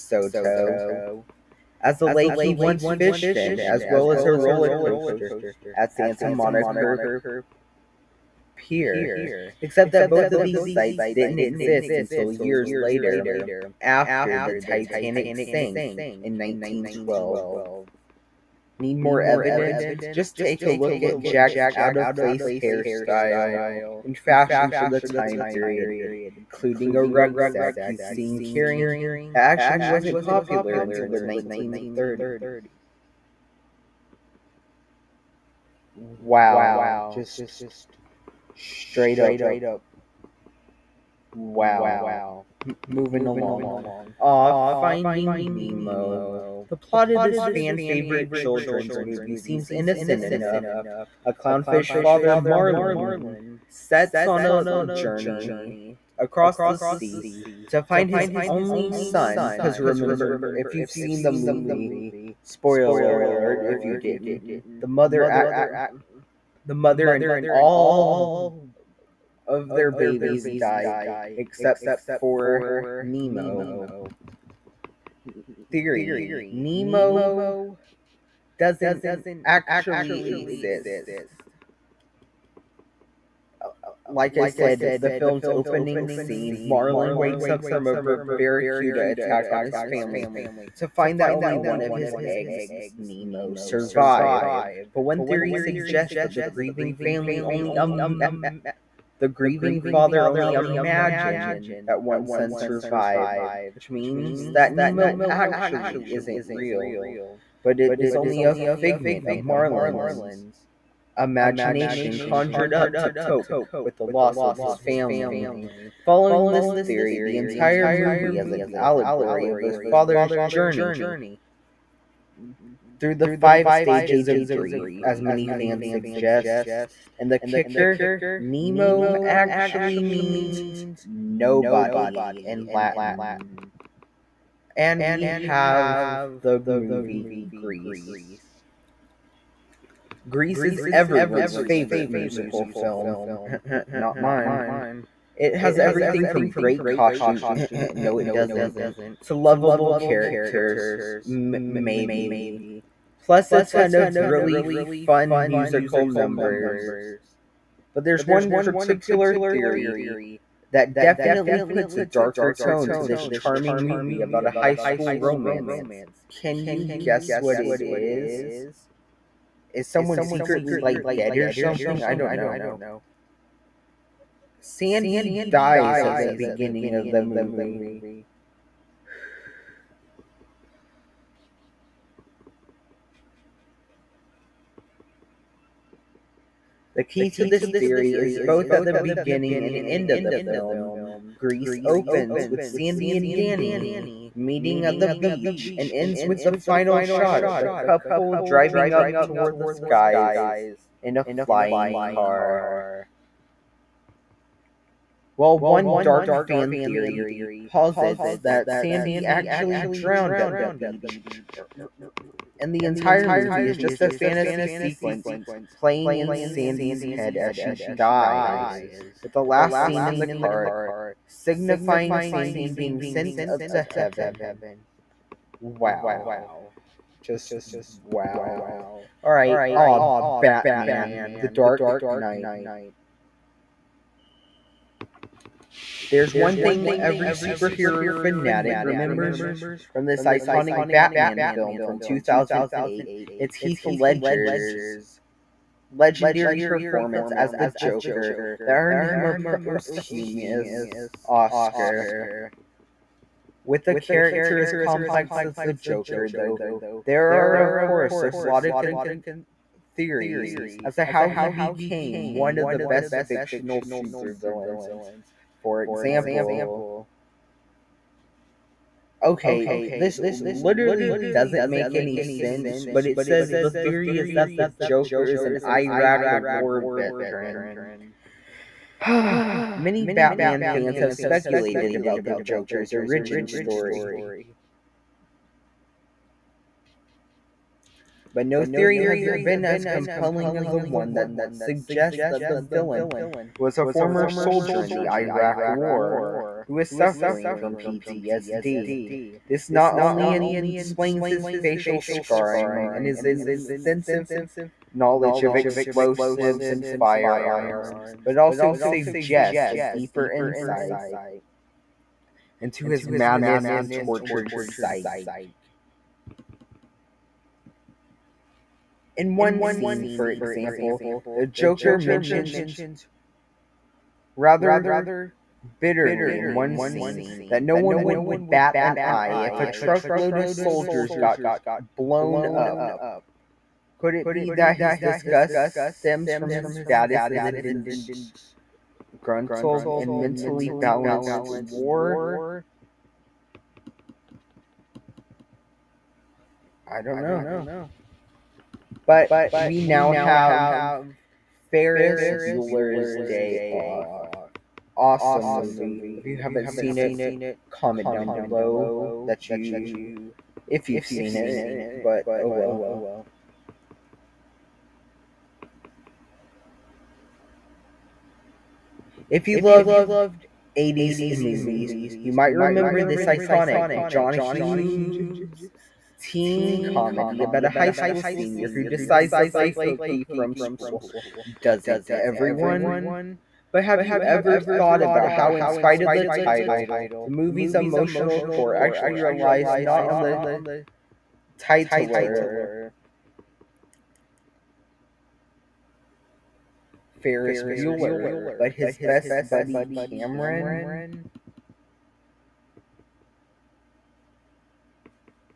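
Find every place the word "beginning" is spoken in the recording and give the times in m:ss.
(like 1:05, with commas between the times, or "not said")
2:56, 3:08.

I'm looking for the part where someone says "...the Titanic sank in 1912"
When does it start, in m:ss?
0:14.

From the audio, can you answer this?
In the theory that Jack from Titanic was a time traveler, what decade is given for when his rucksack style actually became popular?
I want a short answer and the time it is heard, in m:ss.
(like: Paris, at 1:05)
1930s, at 0:31.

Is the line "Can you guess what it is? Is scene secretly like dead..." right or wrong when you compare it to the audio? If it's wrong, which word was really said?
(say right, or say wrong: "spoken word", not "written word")
wrong: "someone", not "scene".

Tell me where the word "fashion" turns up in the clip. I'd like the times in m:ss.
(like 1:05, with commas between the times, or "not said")
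0:24.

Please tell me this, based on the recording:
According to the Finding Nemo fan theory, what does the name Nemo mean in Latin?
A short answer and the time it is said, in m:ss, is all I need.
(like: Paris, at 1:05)
nobody, at 2:11.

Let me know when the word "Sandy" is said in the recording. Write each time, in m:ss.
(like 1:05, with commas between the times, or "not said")
2:54, 3:12, 3:28, 3:36, 3:42.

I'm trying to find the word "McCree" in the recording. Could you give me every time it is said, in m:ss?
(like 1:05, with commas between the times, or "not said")
not said.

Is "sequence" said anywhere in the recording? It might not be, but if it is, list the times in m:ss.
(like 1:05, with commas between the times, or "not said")
3:34.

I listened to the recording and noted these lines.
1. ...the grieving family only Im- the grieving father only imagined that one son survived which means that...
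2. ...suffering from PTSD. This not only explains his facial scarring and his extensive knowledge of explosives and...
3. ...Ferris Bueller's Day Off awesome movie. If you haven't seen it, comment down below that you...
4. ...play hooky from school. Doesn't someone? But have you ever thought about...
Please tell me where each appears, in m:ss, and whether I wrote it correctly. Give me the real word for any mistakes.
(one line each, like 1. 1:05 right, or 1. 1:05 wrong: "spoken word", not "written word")
1. 1:36 right
2. 4:56 right
3. 5:51 right
4. 6:19 wrong: "everyone", not "someone".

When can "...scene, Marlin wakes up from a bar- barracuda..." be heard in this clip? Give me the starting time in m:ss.
1:26.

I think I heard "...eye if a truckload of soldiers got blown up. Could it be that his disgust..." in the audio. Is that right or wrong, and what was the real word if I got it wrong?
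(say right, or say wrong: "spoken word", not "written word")
right.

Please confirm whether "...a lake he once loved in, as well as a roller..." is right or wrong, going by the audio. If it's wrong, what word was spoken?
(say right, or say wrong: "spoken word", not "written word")
wrong: "fished", not "loved".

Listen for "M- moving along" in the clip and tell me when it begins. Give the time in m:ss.
0:42.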